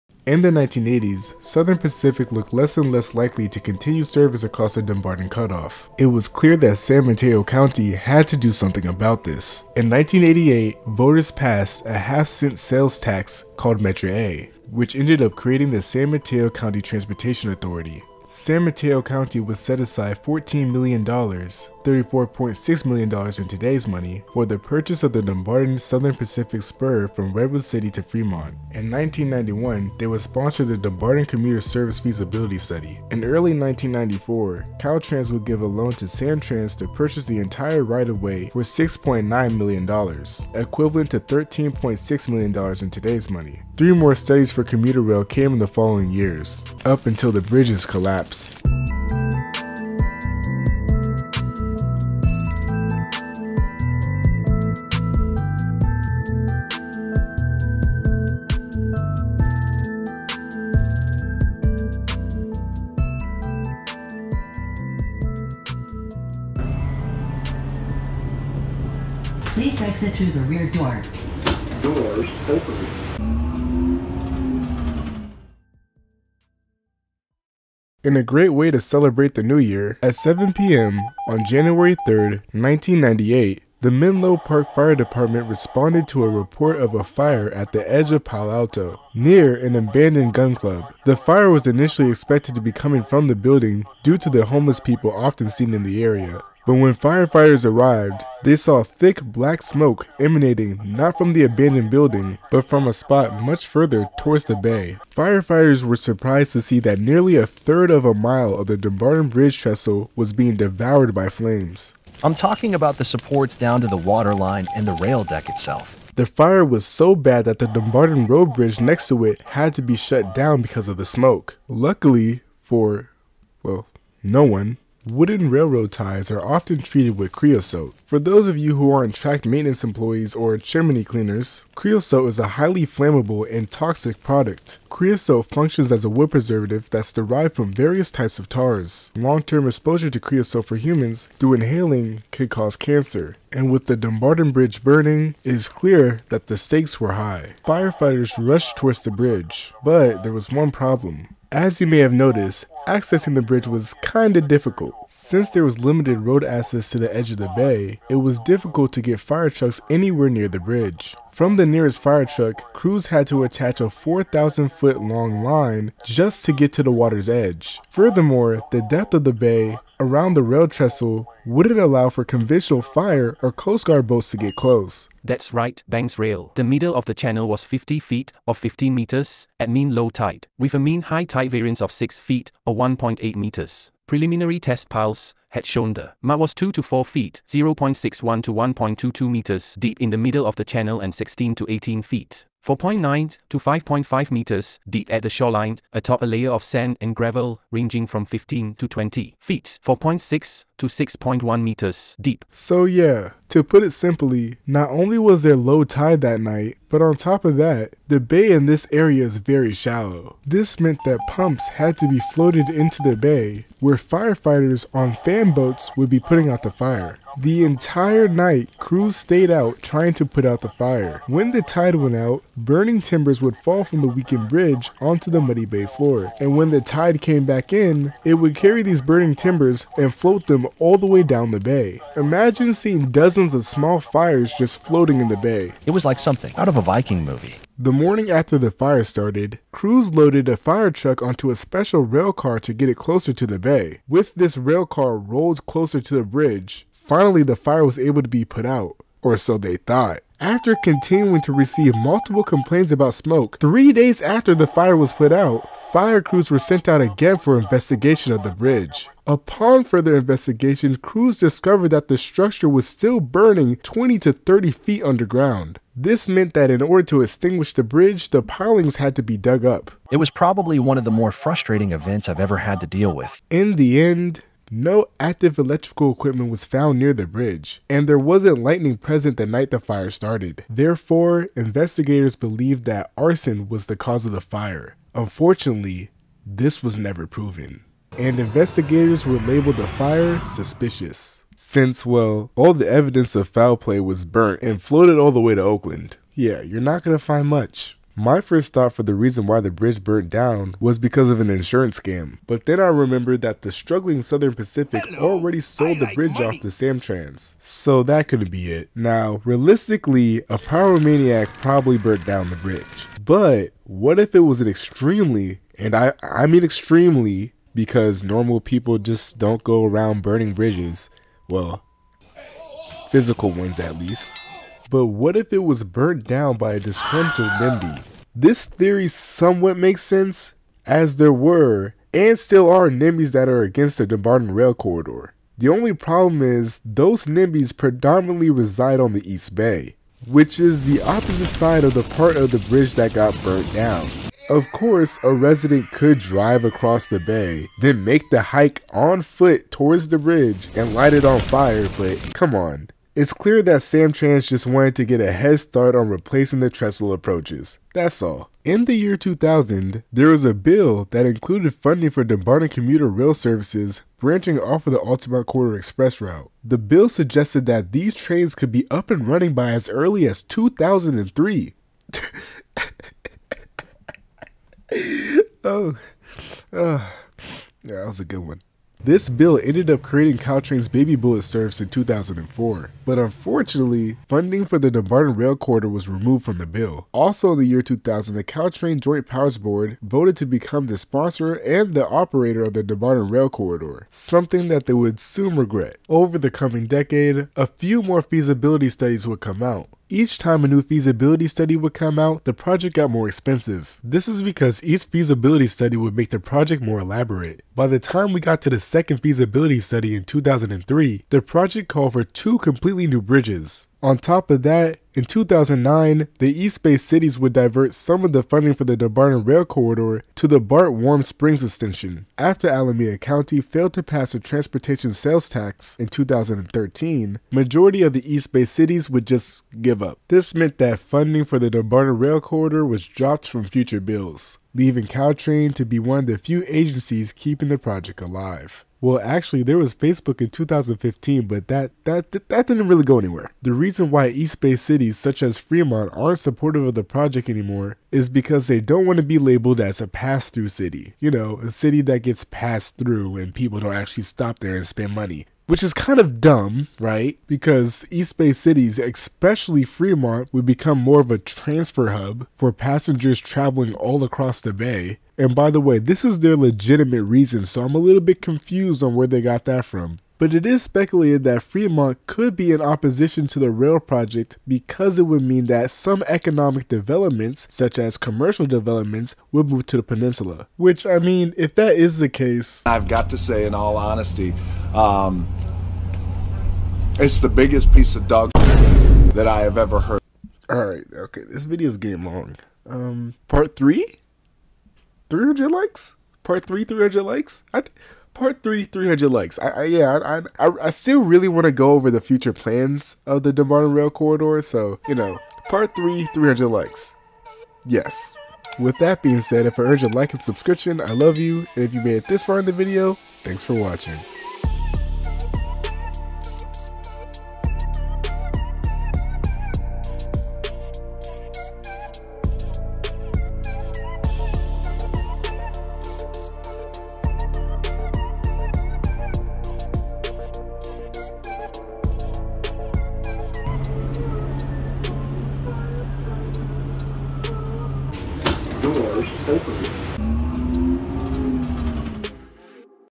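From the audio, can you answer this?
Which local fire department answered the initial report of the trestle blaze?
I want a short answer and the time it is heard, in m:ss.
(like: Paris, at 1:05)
Menlo Park Fire Department, at 1:23.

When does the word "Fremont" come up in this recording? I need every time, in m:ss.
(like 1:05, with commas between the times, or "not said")
0:28, 7:25, 7:39, 7:51.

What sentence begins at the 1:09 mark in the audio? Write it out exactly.
Please exit through the rear door.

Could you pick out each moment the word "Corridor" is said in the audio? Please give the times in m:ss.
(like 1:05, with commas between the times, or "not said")
5:34, 6:05, 6:25, 6:33, 6:59, 7:12, 8:24.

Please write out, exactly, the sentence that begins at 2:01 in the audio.
Luckily for, well, no one, Wooden railroad ties are often treated with creosote.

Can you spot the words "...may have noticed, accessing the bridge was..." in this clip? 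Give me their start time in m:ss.
2:31.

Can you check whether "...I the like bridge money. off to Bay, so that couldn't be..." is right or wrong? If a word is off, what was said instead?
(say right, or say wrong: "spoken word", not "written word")
wrong: "Samtrans", not "Bay".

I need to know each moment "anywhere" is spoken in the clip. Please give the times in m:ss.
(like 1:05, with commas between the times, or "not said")
2:39, 7:23.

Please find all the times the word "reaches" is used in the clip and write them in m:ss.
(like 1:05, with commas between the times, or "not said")
not said.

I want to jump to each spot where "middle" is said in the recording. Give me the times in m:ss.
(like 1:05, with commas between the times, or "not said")
2:56, 3:10.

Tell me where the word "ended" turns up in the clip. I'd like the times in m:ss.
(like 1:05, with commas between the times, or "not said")
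0:14, 6:19.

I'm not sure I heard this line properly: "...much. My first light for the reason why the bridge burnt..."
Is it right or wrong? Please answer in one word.
wrong.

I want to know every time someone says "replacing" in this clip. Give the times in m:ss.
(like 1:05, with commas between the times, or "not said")
5:56.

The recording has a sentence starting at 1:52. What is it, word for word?
I'm talking about the supports down to the waterline and the rail deck itself.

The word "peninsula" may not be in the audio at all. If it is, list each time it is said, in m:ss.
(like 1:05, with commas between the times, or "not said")
8:00.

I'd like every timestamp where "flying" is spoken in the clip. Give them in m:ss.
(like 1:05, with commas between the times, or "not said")
not said.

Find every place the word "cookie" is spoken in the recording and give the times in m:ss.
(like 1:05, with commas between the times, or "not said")
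not said.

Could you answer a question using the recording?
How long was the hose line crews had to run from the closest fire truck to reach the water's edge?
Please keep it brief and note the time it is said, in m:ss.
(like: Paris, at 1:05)
4,000 feet, at 2:43.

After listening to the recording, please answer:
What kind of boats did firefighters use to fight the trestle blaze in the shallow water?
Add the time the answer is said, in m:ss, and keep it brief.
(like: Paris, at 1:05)
fan boats, at 3:35.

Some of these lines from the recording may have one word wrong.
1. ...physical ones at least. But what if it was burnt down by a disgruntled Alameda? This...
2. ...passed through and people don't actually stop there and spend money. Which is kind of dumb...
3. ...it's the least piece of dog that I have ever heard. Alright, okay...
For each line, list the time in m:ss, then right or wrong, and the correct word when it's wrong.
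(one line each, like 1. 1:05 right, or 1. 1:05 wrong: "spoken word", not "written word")
1. 5:23 wrong: "NIMBY", not "Alameda"
2. 7:32 right
3. 8:07 wrong: "biggest", not "least".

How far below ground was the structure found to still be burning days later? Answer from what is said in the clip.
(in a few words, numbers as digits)
20 to 30 feet.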